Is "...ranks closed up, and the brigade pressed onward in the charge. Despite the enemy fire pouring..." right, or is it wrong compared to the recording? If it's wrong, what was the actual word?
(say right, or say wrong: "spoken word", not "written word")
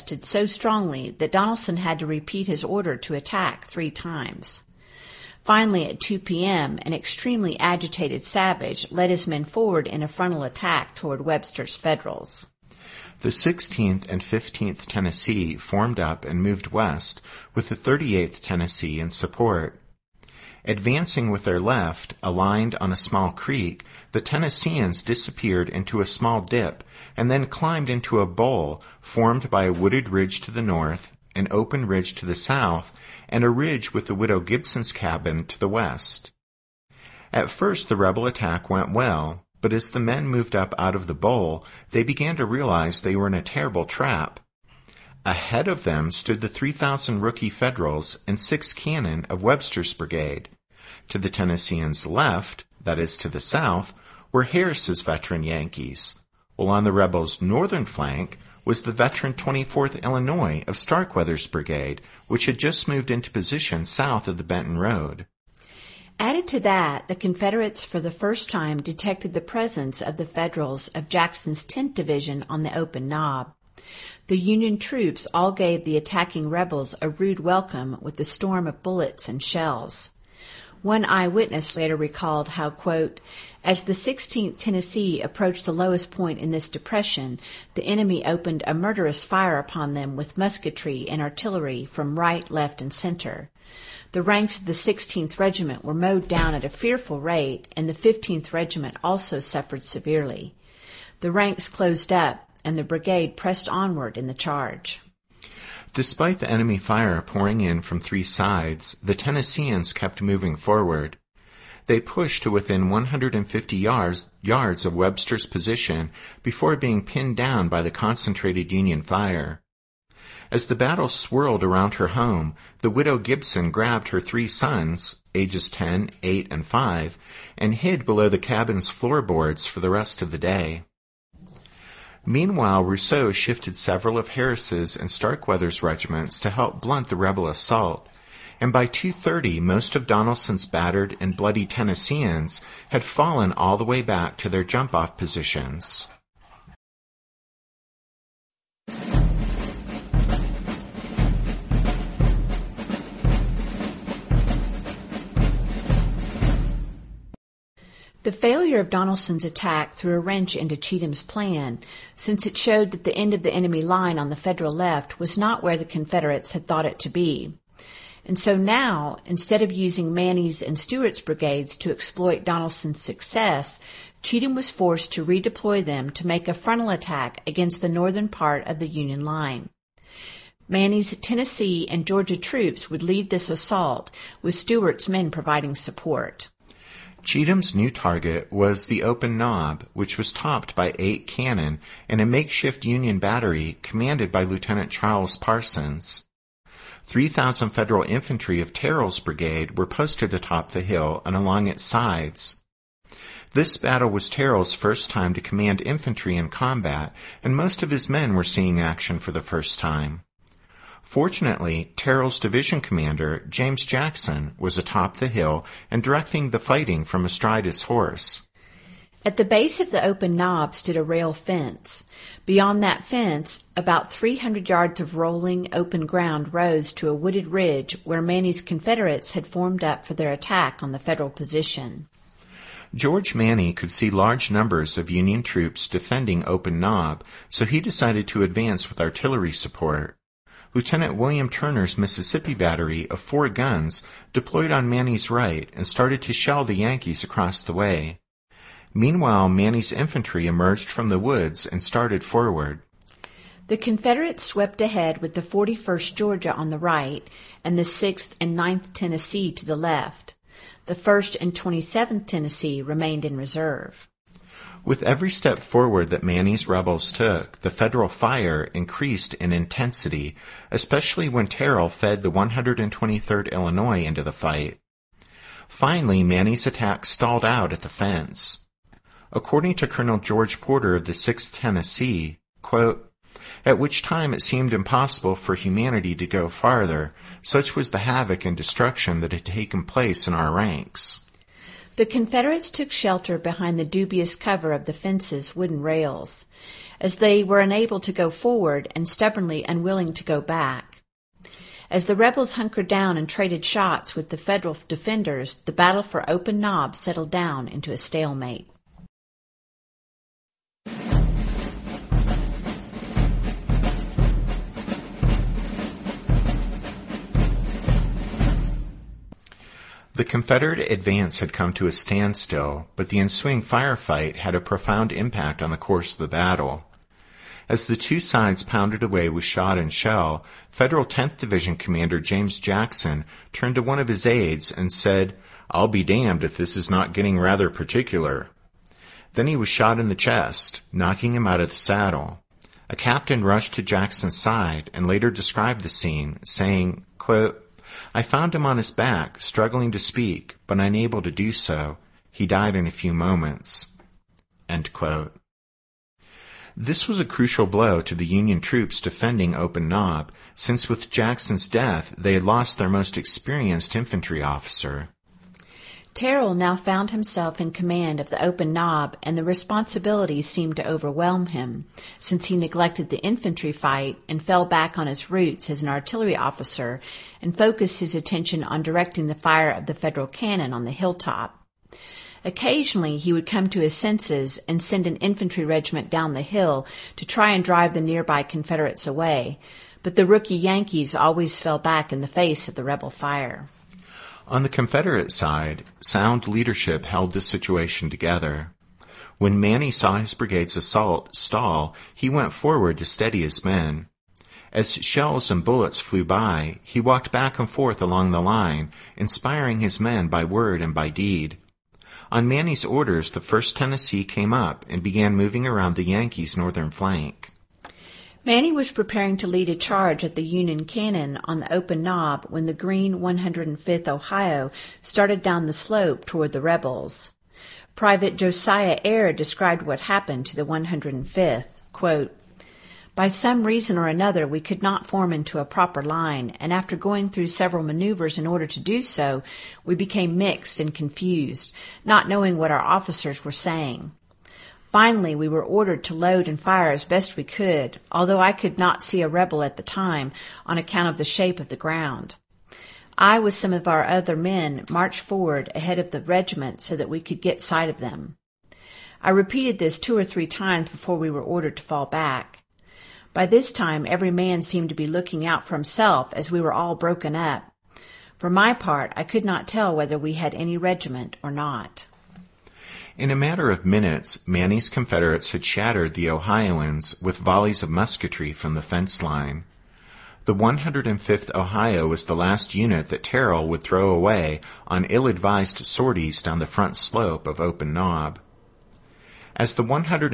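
right.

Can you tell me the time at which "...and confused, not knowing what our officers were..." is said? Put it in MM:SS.
07:20.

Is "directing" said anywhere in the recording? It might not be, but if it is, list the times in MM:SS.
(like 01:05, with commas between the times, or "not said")
03:36, 06:18.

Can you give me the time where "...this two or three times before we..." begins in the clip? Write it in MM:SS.
07:39.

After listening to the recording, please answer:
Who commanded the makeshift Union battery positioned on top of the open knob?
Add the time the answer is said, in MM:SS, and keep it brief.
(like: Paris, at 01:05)
Lieutenant Charles Parsons, at 03:14.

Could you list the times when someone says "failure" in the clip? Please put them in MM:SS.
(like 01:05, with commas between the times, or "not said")
02:38.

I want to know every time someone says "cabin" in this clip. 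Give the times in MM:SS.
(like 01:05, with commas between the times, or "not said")
00:34, 02:08.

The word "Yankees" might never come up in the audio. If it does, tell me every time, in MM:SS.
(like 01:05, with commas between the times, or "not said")
00:55, 04:06, 06:30, 06:56.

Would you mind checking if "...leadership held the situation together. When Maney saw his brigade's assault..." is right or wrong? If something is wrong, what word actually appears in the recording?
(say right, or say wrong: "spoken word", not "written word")
right.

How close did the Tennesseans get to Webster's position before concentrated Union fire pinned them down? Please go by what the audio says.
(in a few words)
150 yards.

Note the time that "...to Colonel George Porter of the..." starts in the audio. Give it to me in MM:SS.
04:39.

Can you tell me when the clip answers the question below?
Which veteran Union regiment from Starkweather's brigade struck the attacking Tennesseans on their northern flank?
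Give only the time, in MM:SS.
00:59.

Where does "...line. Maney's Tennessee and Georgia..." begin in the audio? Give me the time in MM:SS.
02:59.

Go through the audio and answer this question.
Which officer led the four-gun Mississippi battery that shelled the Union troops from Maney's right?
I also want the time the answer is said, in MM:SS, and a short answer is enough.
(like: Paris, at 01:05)
Lieutenant William Turner, at 04:00.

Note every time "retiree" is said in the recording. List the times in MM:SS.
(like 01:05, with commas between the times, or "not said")
not said.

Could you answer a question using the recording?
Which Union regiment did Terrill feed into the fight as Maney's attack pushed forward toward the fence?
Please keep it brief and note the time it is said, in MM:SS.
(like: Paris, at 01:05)
123rd Illinois, at 04:32.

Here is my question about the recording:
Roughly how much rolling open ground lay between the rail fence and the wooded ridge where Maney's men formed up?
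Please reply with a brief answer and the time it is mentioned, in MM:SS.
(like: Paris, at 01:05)
300 yards, at 03:44.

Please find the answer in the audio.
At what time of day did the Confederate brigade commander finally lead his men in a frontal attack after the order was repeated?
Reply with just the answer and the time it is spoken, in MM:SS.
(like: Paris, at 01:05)
2 p.m., at 00:05.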